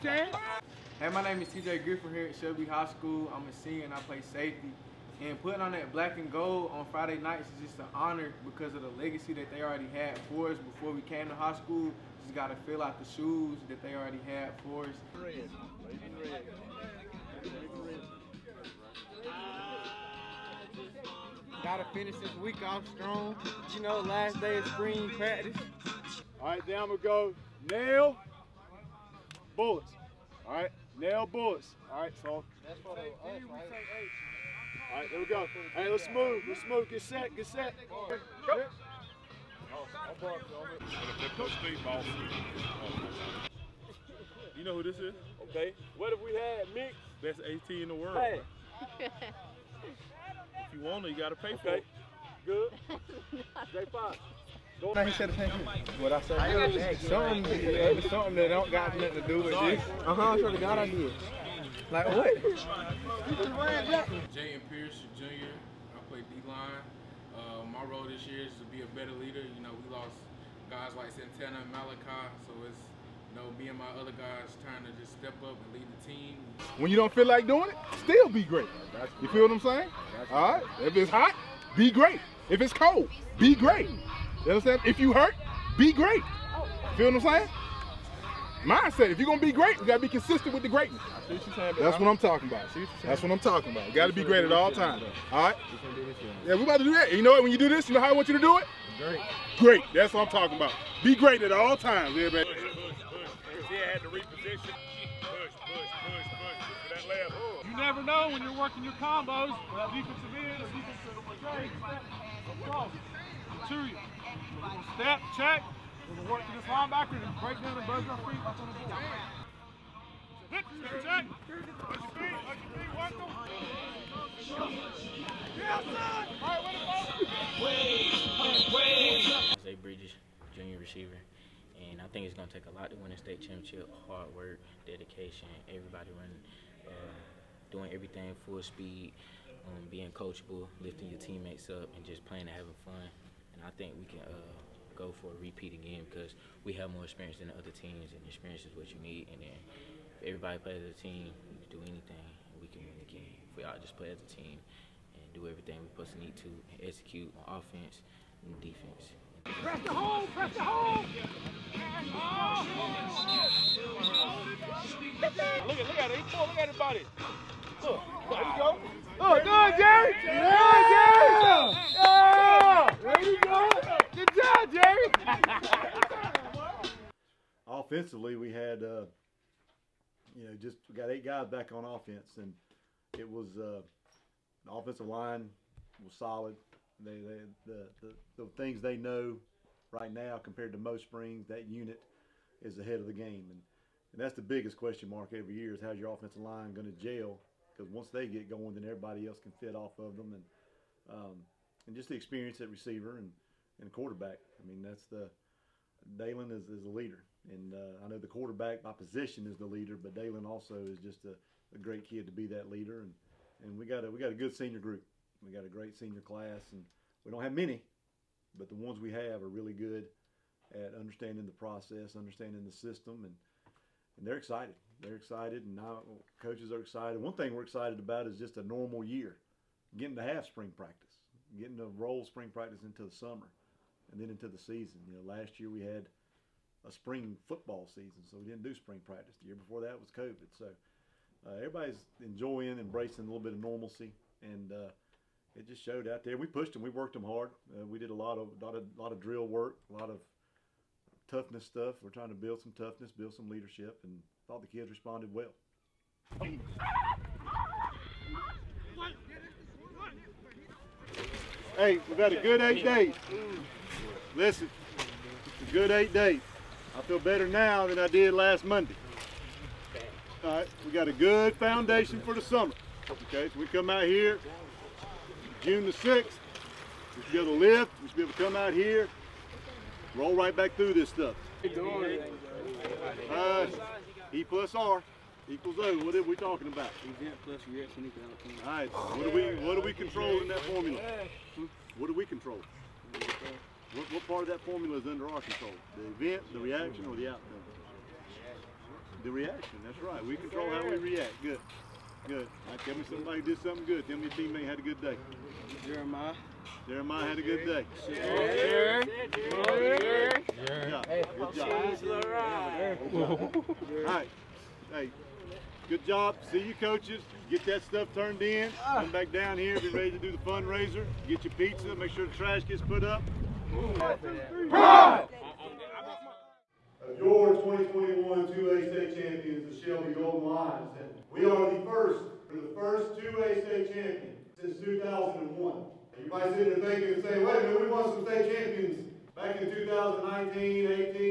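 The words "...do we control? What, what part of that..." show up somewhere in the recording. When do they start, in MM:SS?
04:52.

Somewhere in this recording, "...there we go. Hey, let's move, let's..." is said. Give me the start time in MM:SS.
00:35.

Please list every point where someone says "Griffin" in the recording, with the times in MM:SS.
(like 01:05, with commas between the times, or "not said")
00:01.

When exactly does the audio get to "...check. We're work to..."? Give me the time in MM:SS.
01:55.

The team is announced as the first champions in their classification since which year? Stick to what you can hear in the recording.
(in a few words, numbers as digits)
2001.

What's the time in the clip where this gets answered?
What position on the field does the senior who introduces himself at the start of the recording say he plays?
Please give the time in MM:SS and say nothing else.
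00:04.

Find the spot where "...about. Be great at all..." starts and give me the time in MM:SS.
01:40.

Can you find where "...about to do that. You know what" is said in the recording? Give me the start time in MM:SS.
01:36.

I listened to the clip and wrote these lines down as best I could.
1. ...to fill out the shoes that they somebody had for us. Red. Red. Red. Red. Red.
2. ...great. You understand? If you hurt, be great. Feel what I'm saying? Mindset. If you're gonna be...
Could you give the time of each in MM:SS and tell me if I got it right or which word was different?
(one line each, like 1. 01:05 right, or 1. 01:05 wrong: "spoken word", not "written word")
1. 00:12 wrong: "already", not "somebody"
2. 01:23 right.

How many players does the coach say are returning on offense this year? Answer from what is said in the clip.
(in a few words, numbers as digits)
8.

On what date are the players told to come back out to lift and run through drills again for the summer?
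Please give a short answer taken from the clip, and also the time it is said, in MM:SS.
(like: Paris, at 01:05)
June 6, at 04:35.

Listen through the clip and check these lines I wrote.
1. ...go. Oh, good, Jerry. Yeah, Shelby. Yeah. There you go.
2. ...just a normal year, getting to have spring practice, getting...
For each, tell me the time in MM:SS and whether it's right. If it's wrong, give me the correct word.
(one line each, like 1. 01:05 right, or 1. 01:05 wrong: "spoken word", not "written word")
1. 02:48 wrong: "Jerry", not "Shelby"
2. 03:48 right.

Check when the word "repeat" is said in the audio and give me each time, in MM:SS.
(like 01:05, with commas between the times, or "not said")
02:25.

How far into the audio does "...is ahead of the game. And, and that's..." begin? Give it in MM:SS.
03:12.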